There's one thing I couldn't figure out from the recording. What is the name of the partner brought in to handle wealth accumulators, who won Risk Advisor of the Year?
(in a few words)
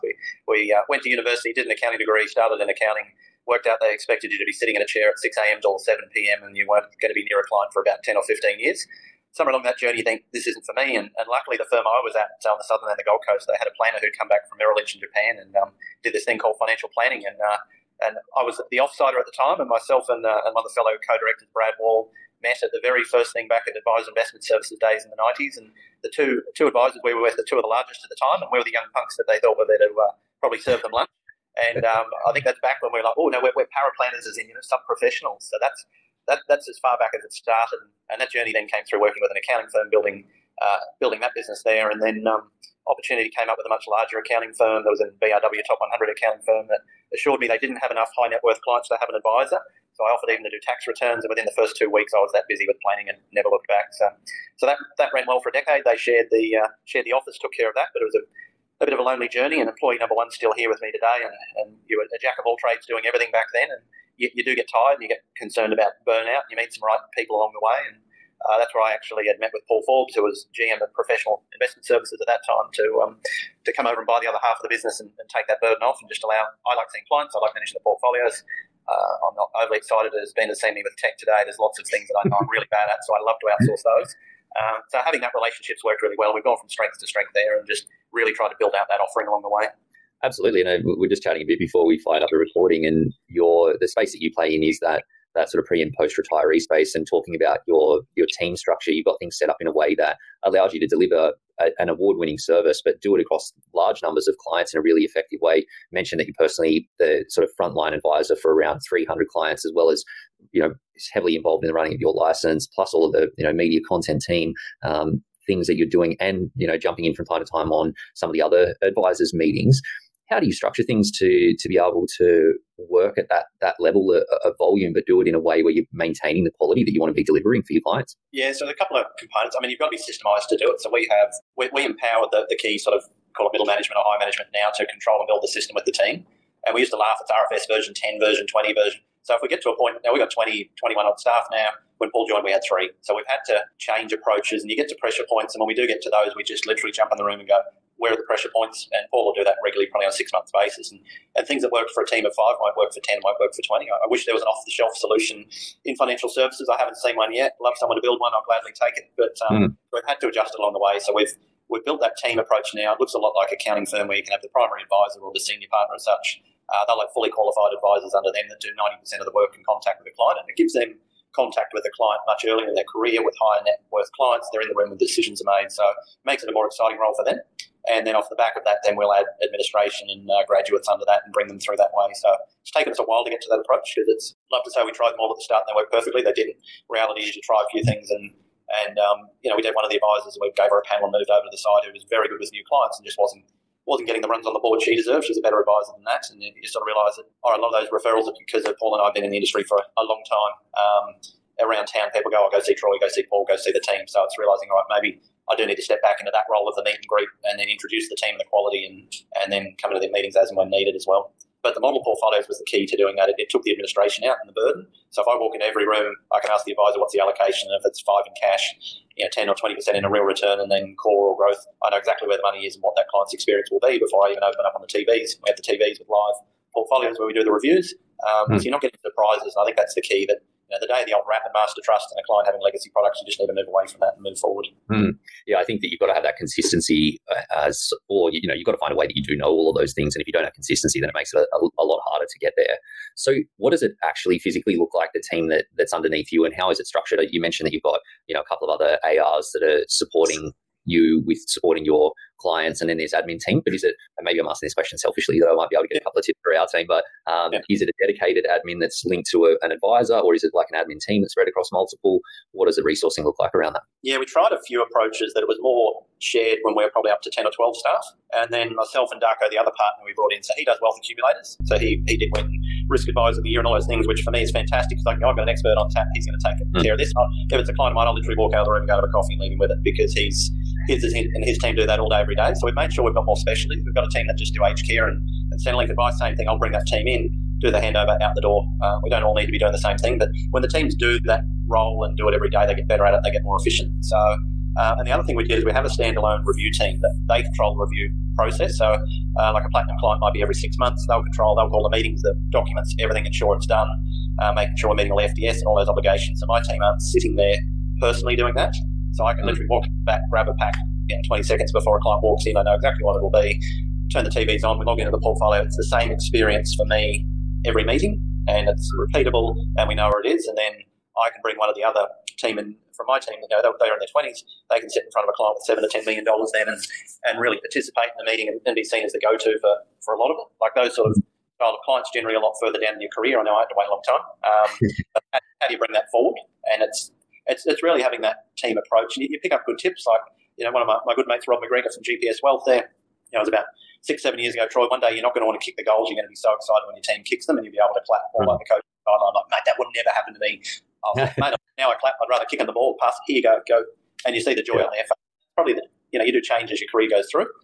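Darko.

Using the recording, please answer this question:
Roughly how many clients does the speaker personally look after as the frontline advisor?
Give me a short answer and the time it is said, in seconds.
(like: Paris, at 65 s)
300, at 108 s.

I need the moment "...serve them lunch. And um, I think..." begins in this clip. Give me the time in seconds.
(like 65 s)
30 s.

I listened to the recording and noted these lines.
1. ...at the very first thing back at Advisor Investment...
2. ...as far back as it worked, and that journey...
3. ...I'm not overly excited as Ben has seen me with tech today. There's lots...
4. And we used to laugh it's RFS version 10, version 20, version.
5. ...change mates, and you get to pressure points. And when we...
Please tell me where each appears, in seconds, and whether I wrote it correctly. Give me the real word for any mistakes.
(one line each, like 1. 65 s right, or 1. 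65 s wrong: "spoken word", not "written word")
1. 22 s right
2. 36 s wrong: "started", not "worked"
3. 79 s right
4. 136 s right
5. 143 s wrong: "approaches", not "mates".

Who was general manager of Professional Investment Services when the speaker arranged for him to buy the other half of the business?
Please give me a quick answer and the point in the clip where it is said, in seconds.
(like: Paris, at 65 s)
Paul Forbes, at 69 s.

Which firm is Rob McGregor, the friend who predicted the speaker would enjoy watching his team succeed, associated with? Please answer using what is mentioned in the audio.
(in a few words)
GPS Wealth.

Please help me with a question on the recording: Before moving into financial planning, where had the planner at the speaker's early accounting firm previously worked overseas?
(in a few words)
Merrill Lynch in Japan.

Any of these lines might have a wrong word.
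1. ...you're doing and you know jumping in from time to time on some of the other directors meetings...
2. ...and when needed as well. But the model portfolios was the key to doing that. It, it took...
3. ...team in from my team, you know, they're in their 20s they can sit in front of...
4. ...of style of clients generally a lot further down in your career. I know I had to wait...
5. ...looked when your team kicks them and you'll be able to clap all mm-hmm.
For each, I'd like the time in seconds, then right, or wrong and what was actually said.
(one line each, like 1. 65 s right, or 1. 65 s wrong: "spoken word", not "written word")
1. 115 s wrong: "advisors", not "directors"
2. 210 s right
3. 322 s right
4. 331 s right
5. 346 s wrong: "excited", not "looked".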